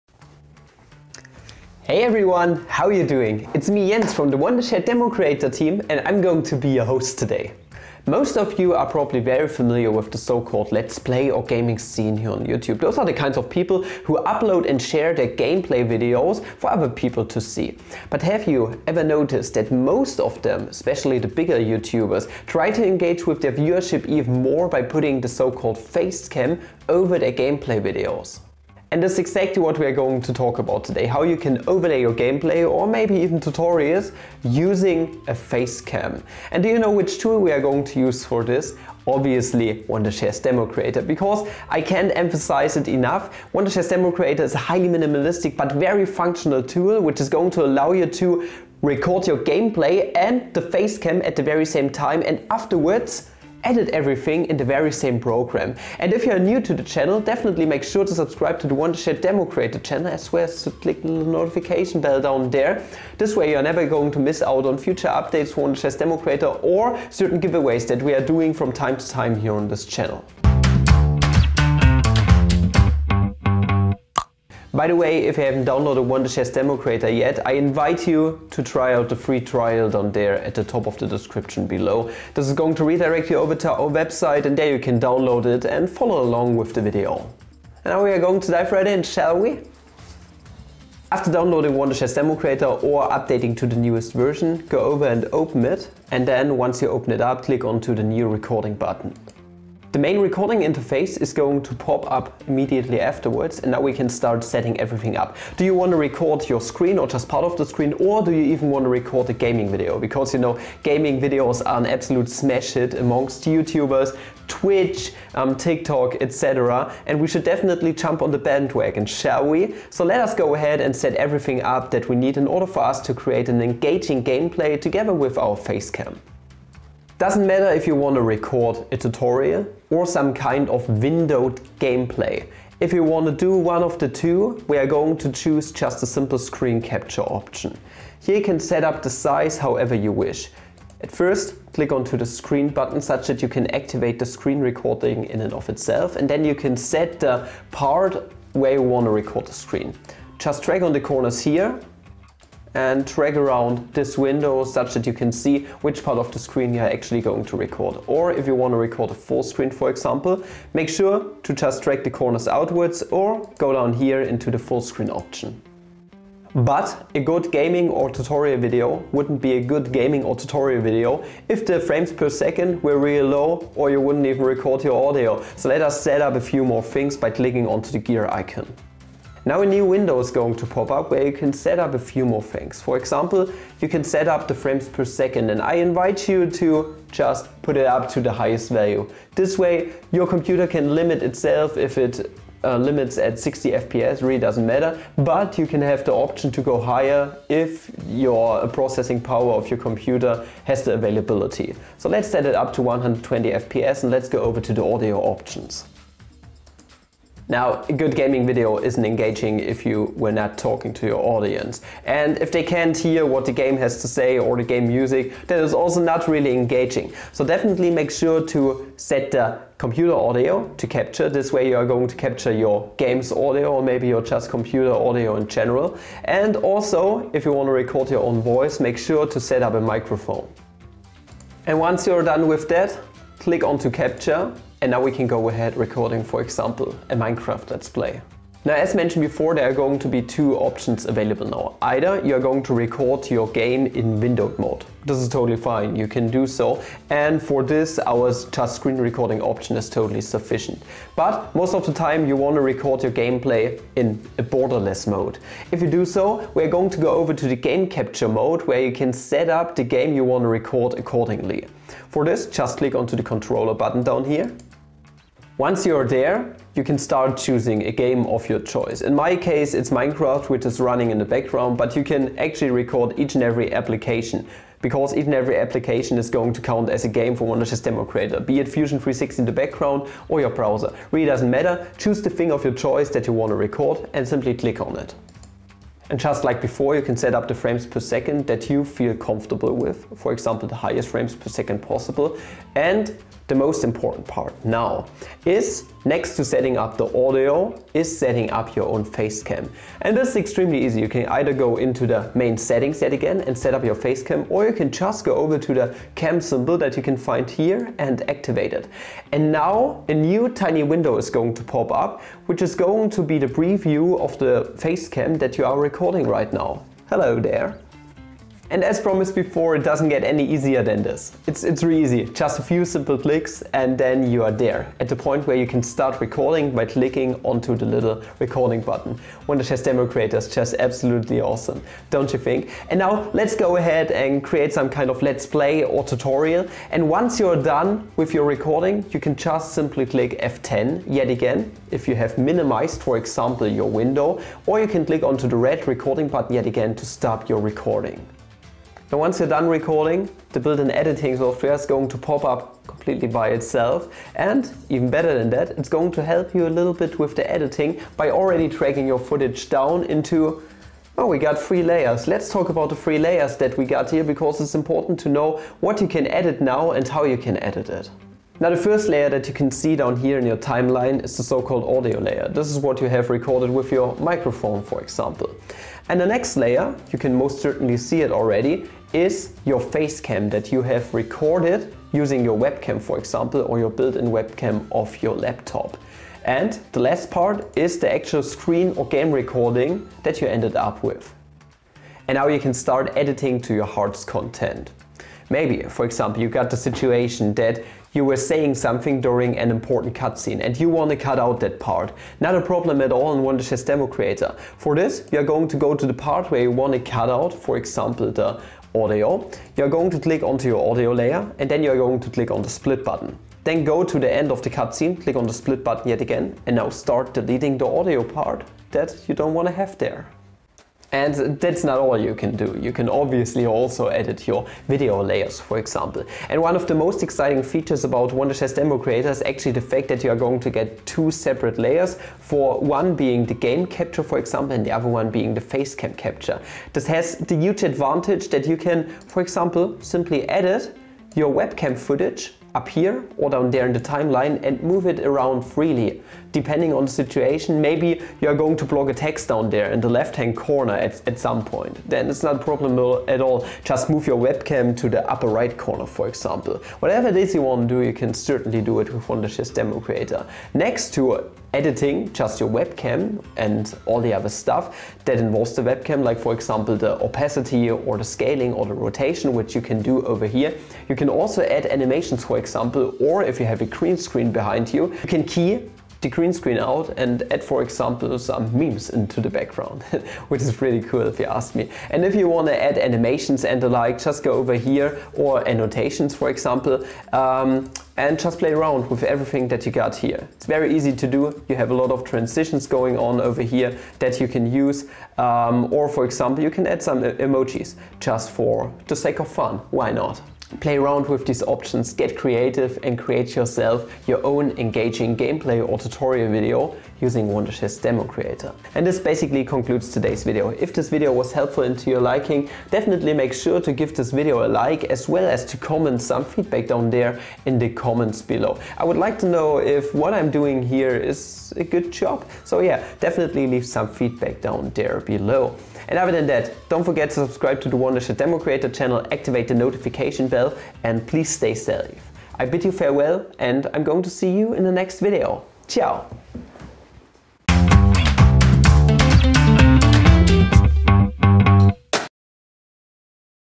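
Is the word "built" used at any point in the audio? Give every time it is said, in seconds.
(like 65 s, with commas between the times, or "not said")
350 s, 383 s.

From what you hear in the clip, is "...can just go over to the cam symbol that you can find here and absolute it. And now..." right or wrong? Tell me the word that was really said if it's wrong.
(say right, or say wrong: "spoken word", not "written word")
wrong: "activate", not "absolute".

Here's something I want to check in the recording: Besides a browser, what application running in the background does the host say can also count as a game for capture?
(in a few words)
Fusion 360.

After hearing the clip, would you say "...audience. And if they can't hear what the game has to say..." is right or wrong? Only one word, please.
right.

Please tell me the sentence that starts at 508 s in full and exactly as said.
And this basically concludes today's video.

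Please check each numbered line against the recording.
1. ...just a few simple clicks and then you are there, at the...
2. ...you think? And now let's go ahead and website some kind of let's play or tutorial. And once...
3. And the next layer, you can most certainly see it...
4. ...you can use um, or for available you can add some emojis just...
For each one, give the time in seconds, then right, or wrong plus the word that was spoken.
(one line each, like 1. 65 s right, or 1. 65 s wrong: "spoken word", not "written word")
1. 322 s right
2. 332 s wrong: "create", not "website"
3. 376 s right
4. 494 s wrong: "example", not "available".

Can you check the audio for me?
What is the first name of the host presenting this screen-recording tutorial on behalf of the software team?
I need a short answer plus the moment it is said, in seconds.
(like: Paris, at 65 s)
Jens, at 3 s.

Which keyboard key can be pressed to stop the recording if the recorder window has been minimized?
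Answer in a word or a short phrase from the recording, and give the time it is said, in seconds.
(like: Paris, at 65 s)
F10, at 340 s.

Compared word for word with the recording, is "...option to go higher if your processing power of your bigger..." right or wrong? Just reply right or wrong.
wrong.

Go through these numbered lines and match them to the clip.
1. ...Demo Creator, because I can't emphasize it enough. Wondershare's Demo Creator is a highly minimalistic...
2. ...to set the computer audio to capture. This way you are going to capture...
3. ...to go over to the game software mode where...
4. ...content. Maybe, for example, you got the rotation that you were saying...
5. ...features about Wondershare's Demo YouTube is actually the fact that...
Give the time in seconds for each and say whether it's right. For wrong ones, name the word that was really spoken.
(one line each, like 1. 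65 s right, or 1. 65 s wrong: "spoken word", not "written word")
1. 40 s right
2. 218 s right
3. 256 s wrong: "capture", not "software"
4. 394 s wrong: "situation", not "rotation"
5. 427 s wrong: "Creator", not "YouTube".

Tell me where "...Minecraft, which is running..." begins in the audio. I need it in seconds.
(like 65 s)
269 s.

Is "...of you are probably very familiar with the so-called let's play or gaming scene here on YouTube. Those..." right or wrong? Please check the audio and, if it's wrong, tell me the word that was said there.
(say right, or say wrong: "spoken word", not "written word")
right.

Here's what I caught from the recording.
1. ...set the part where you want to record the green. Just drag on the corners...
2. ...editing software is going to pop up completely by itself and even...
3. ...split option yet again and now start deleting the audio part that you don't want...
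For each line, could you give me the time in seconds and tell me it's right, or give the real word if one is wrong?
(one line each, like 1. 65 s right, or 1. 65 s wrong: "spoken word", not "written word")
1. 146 s wrong: "screen", not "green"
2. 350 s right
3. 415 s wrong: "button", not "option".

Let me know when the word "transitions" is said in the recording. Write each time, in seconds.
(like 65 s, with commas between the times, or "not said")
492 s.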